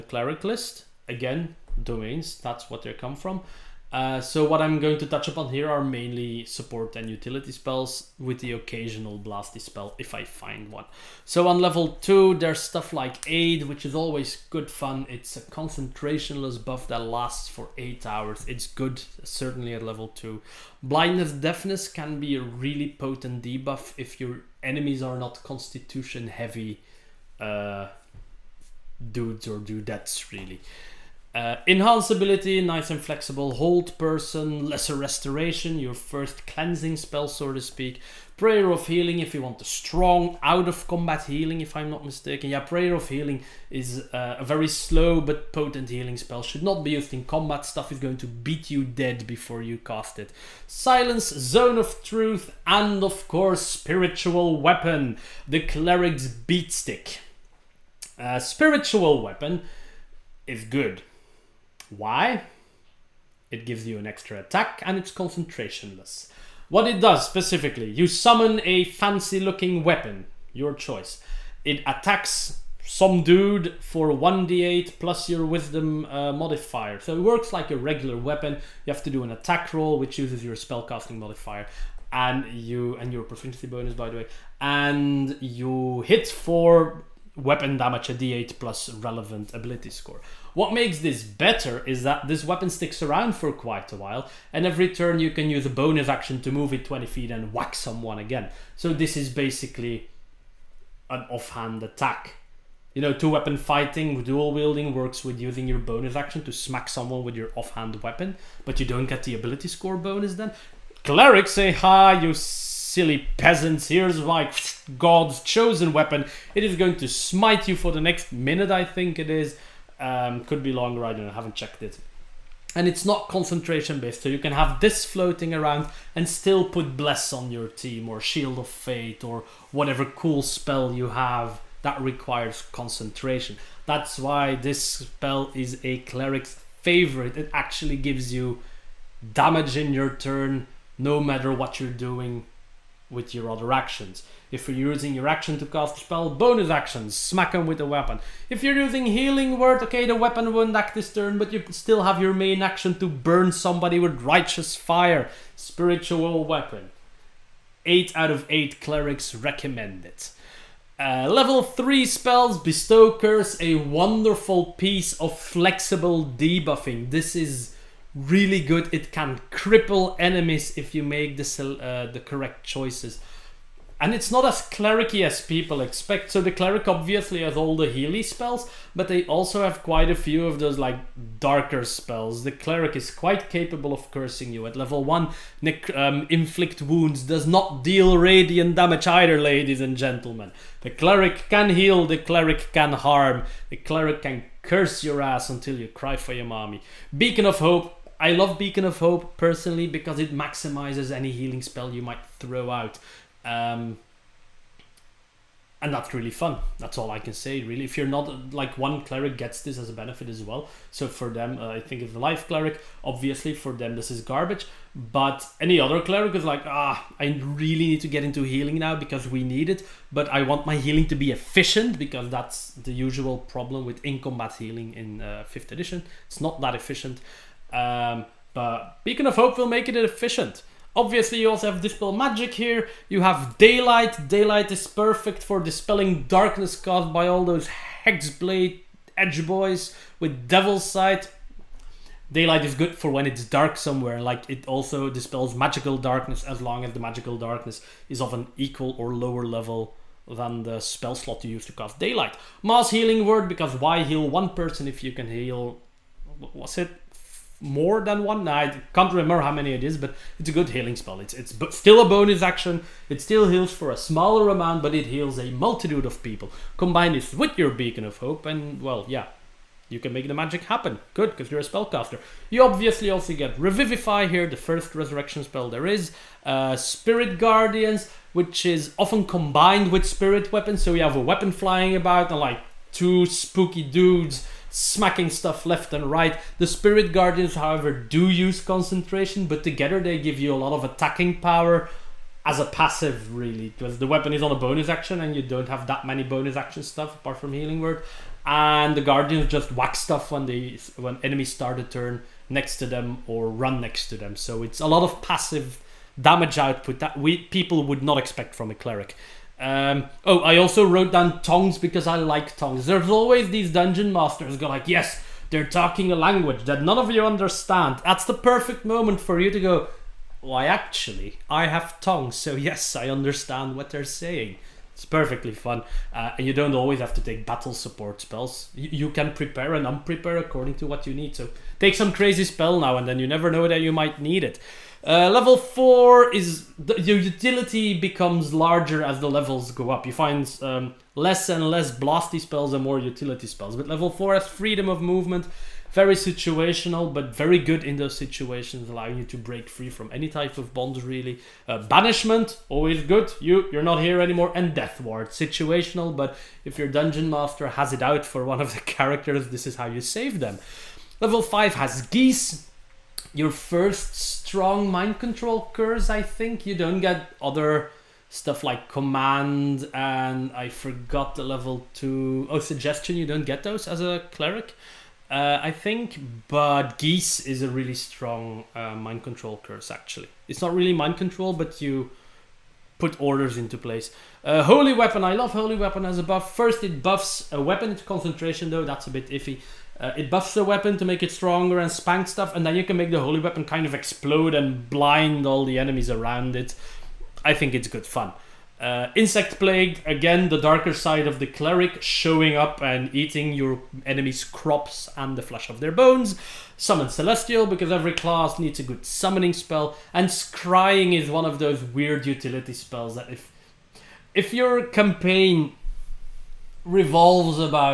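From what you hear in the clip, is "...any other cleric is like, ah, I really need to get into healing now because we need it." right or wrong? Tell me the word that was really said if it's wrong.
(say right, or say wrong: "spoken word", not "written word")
right.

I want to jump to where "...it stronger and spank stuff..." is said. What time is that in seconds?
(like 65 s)
391 s.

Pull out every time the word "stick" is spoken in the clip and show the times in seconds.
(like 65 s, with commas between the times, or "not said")
56 s, 92 s.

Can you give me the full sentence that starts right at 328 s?
you can prepare and unprepare according to what you need.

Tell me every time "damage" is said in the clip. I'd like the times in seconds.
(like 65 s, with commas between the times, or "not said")
87 s, 139 s, 188 s, 306 s.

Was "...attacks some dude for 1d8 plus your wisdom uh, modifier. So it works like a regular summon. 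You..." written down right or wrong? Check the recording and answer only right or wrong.
wrong.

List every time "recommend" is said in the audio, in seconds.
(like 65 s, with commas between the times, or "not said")
159 s.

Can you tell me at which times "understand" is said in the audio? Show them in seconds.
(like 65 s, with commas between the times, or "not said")
317 s, 323 s.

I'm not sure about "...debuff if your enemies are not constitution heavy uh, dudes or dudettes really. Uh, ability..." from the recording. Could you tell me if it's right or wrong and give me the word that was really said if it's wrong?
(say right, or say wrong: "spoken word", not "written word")
right.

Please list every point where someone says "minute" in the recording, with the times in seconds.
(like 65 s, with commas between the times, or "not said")
118 s.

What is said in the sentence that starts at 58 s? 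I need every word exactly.
Uh, spiritual weapon is good why?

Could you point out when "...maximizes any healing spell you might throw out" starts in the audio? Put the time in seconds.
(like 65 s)
200 s.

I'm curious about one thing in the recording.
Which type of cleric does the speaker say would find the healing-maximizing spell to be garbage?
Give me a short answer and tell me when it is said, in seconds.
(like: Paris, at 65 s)
Life cleric, at 212 s.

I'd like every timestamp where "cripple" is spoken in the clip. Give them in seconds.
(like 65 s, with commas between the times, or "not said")
169 s.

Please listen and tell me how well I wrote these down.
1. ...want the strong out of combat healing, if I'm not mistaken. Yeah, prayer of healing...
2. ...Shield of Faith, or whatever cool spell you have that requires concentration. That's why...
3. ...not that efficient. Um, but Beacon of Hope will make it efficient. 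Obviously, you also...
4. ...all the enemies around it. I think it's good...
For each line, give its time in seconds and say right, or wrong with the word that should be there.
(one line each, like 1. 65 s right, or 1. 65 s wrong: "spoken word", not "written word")
1. 39 s right
2. 128 s right
3. 226 s right
4. 395 s right.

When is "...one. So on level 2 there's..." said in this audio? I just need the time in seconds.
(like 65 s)
10 s.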